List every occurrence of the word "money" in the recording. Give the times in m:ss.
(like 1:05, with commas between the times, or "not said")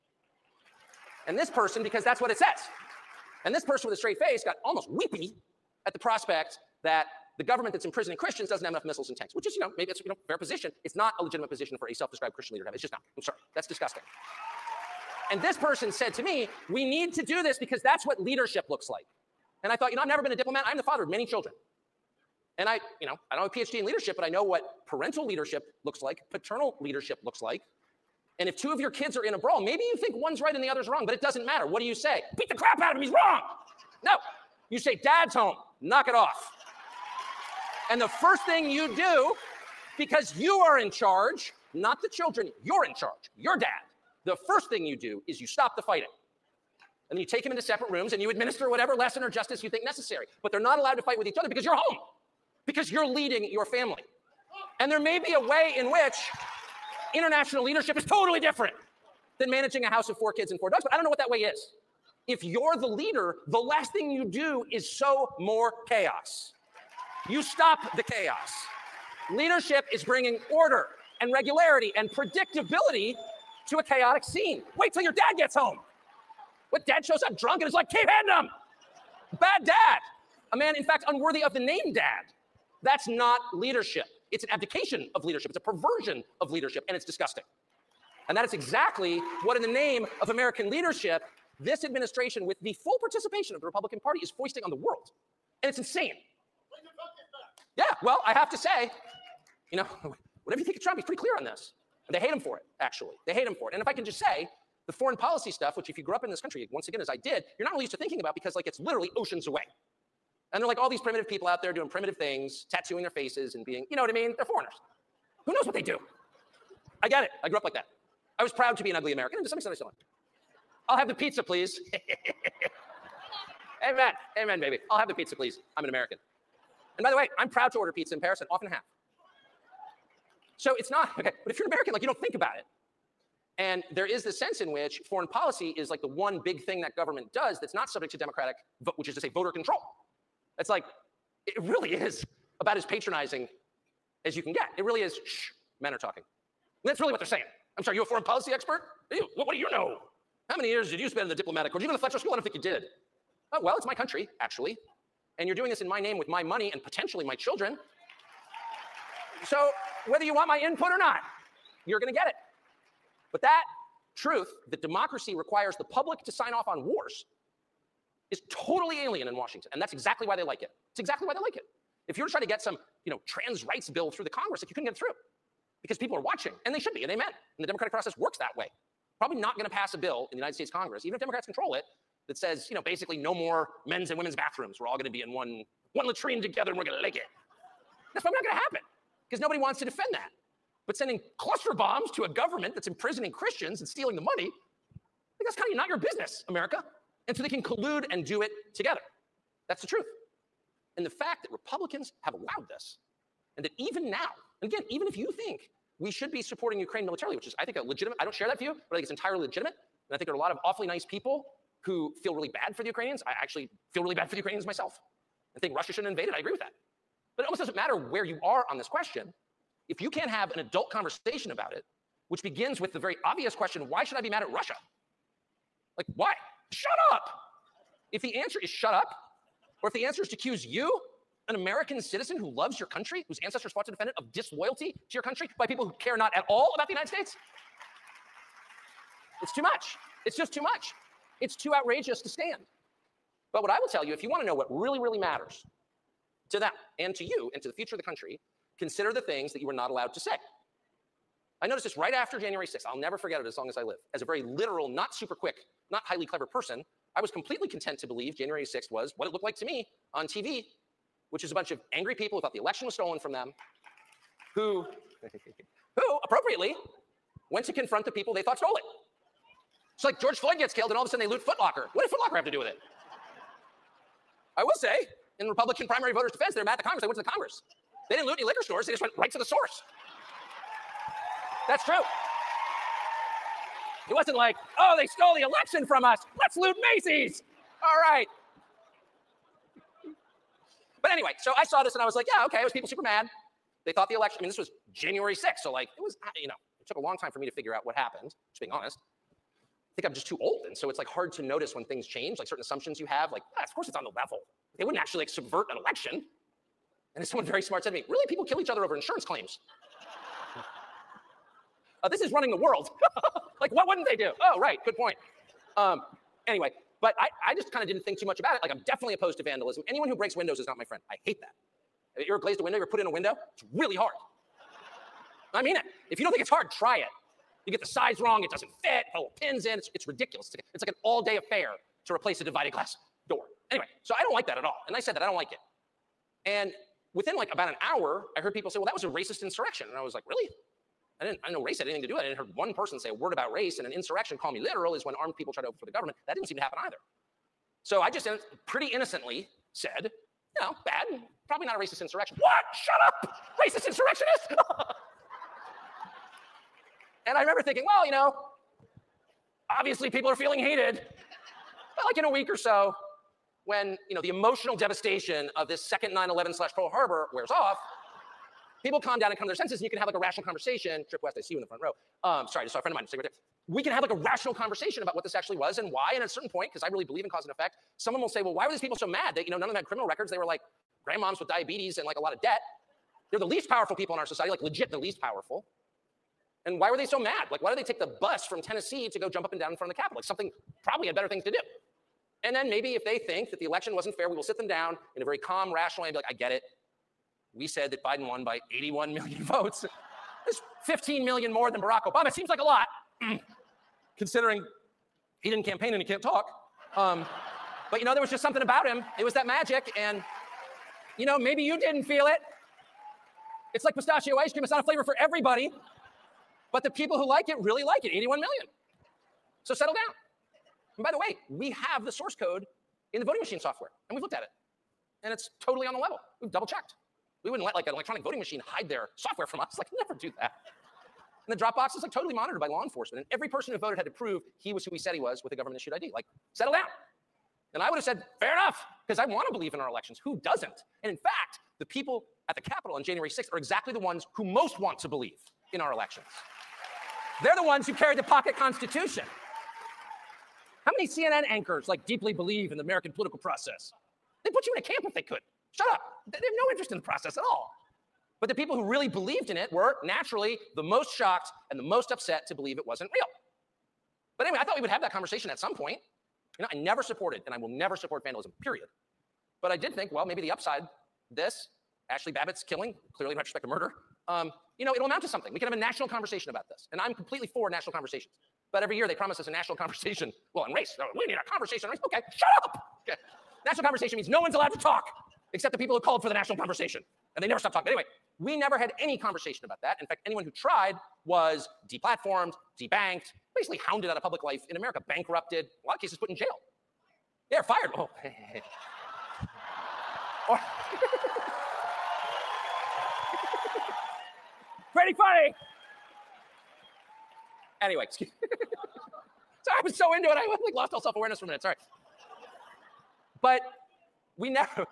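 2:36, 3:14.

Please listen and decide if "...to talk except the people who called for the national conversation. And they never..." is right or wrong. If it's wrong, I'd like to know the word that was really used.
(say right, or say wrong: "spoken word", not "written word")
right.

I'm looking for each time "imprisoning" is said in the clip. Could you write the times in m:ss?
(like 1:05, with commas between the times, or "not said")
0:07, 3:12.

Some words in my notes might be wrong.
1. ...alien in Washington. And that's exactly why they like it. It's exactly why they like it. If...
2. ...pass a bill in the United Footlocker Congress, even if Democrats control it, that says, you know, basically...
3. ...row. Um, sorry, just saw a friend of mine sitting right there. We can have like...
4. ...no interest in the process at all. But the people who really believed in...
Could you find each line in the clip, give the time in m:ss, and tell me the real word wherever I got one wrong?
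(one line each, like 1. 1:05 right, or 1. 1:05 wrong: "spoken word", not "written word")
1. 2:49 right
2. 2:59 wrong: "States", not "Footlocker"
3. 6:11 right
4. 7:36 right.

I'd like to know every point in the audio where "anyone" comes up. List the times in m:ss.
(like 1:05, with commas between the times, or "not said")
5:19, 8:10.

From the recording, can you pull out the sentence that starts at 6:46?
Um, but you know, there was just something about him.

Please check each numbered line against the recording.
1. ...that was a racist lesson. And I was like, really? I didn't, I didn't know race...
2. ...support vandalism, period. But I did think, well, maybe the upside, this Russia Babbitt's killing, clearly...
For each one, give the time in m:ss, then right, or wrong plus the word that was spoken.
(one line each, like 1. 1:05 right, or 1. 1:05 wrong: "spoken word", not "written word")
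1. 5:38 wrong: "insurrection", not "lesson"
2. 7:47 wrong: "Ashli", not "Russia".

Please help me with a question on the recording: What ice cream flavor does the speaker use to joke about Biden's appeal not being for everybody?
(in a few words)
Pistachio.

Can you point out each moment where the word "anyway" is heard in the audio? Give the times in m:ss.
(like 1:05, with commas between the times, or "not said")
4:51, 5:16, 5:33, 7:44, 8:07, 8:27.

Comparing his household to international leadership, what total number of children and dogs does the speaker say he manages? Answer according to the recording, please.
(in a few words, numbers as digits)
4.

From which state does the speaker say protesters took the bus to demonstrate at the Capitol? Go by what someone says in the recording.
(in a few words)
Tennessee.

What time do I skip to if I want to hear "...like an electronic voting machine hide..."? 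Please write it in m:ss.
7:07.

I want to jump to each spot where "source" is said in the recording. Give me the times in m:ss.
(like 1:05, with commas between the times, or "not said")
4:39, 7:02.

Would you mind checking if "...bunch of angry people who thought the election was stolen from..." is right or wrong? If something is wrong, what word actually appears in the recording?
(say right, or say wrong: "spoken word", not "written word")
right.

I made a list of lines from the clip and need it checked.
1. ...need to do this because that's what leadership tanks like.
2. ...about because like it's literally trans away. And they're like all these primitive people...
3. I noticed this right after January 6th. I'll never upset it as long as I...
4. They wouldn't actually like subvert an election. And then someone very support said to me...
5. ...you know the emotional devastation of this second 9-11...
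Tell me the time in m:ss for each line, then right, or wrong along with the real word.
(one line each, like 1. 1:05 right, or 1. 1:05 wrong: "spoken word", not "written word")
1. 0:16 wrong: "looks", not "tanks"
2. 1:48 wrong: "oceans", not "trans"
3. 4:11 wrong: "forget", not "upset"
4. 5:04 wrong: "smart", not "support"
5. 6:04 right.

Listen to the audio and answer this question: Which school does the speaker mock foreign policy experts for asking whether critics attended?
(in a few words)
Fletcher School.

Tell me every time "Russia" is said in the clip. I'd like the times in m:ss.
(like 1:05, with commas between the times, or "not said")
3:35, 3:44.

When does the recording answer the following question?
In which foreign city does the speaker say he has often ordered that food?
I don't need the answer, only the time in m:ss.
2:08.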